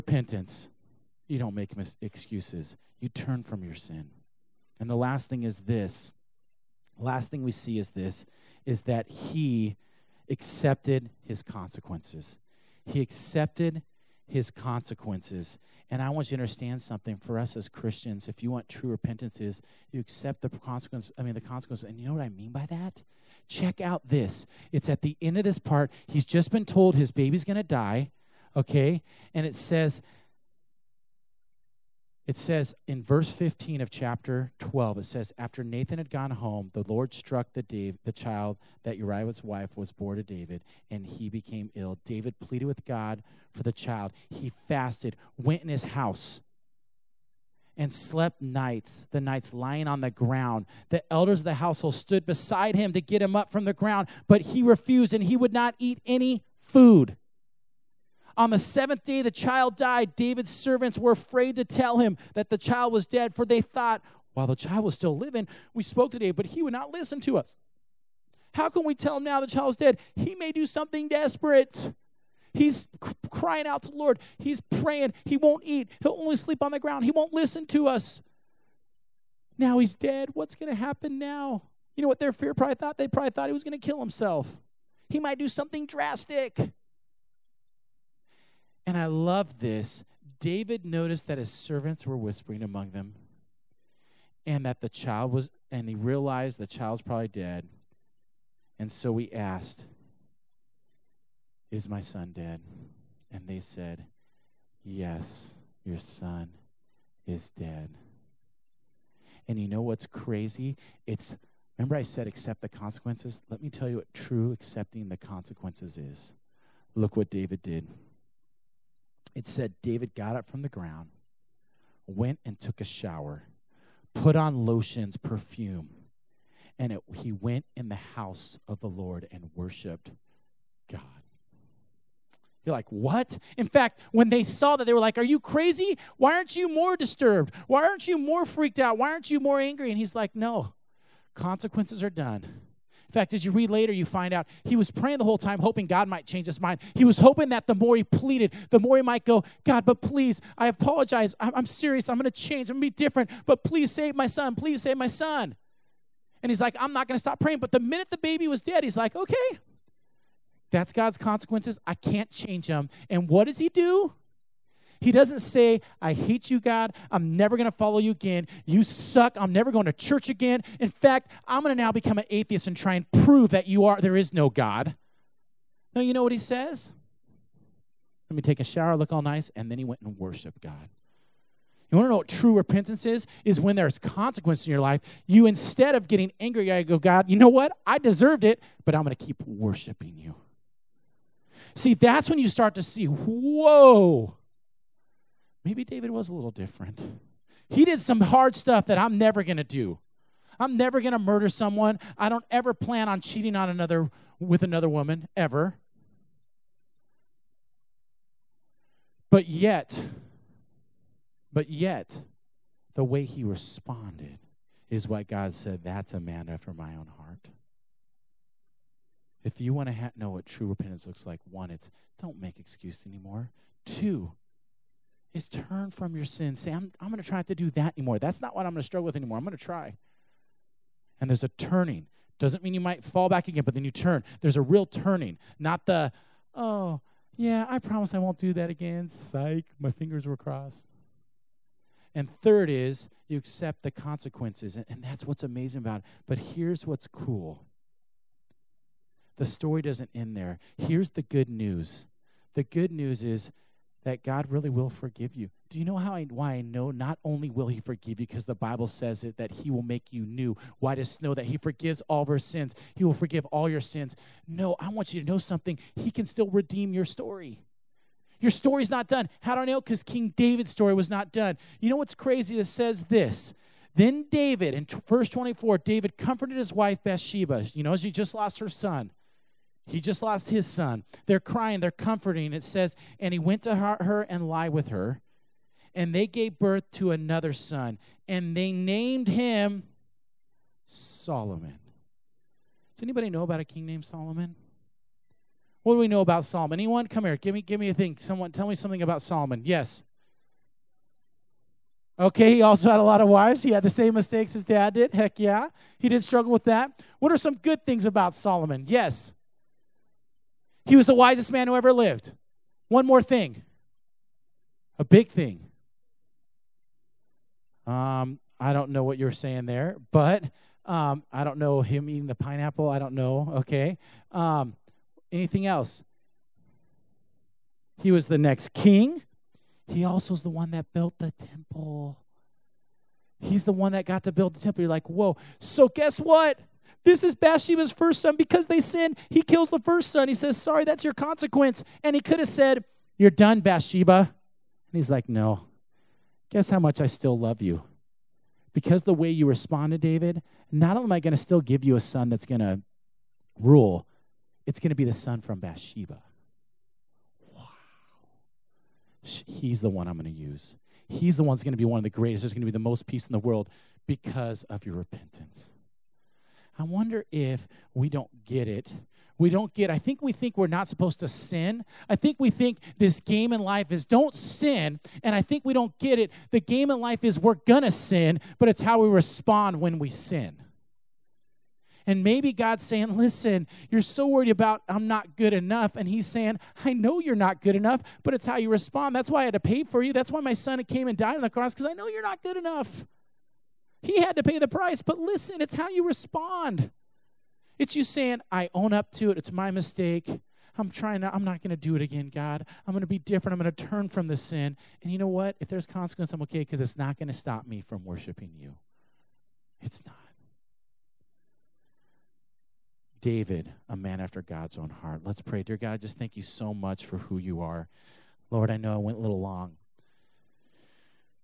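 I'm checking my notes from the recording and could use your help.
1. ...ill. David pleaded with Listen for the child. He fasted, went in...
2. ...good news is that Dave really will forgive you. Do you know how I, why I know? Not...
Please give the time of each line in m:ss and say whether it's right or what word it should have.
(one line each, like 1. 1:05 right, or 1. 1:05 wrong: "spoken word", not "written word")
1. 0:41 wrong: "God", not "Listen"
2. 4:12 wrong: "God", not "Dave".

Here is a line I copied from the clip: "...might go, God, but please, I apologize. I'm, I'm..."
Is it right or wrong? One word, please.
right.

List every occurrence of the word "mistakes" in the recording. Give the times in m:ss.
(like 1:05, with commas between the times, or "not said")
5:04, 6:39.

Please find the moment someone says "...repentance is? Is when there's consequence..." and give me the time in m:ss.
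3:02.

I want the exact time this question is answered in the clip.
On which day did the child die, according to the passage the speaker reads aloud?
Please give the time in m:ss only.
0:58.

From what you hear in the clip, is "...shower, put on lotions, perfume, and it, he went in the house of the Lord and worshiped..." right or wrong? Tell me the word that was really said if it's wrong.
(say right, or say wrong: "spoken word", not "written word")
right.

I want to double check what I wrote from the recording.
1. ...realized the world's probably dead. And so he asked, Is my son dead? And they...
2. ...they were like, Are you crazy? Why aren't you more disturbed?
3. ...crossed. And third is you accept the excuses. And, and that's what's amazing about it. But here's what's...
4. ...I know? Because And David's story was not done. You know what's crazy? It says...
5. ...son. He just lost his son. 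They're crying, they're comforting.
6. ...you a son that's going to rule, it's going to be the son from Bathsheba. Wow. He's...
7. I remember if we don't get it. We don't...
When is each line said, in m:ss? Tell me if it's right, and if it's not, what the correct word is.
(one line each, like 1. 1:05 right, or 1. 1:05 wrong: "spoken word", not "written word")
1. 1:35 wrong: "child", not "world"
2. 2:14 right
3. 4:00 wrong: "consequences", not "excuses"
4. 4:29 wrong: "King", not "And"
5. 4:38 right
6. 5:51 right
7. 6:06 wrong: "wonder", not "remember".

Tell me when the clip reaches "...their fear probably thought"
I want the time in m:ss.
1:22.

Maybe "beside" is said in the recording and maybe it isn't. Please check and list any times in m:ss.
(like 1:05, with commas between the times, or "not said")
0:52.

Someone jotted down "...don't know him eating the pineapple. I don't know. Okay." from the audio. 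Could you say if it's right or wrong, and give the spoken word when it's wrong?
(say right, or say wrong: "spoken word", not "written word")
right.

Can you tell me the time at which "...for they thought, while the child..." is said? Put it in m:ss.
1:03.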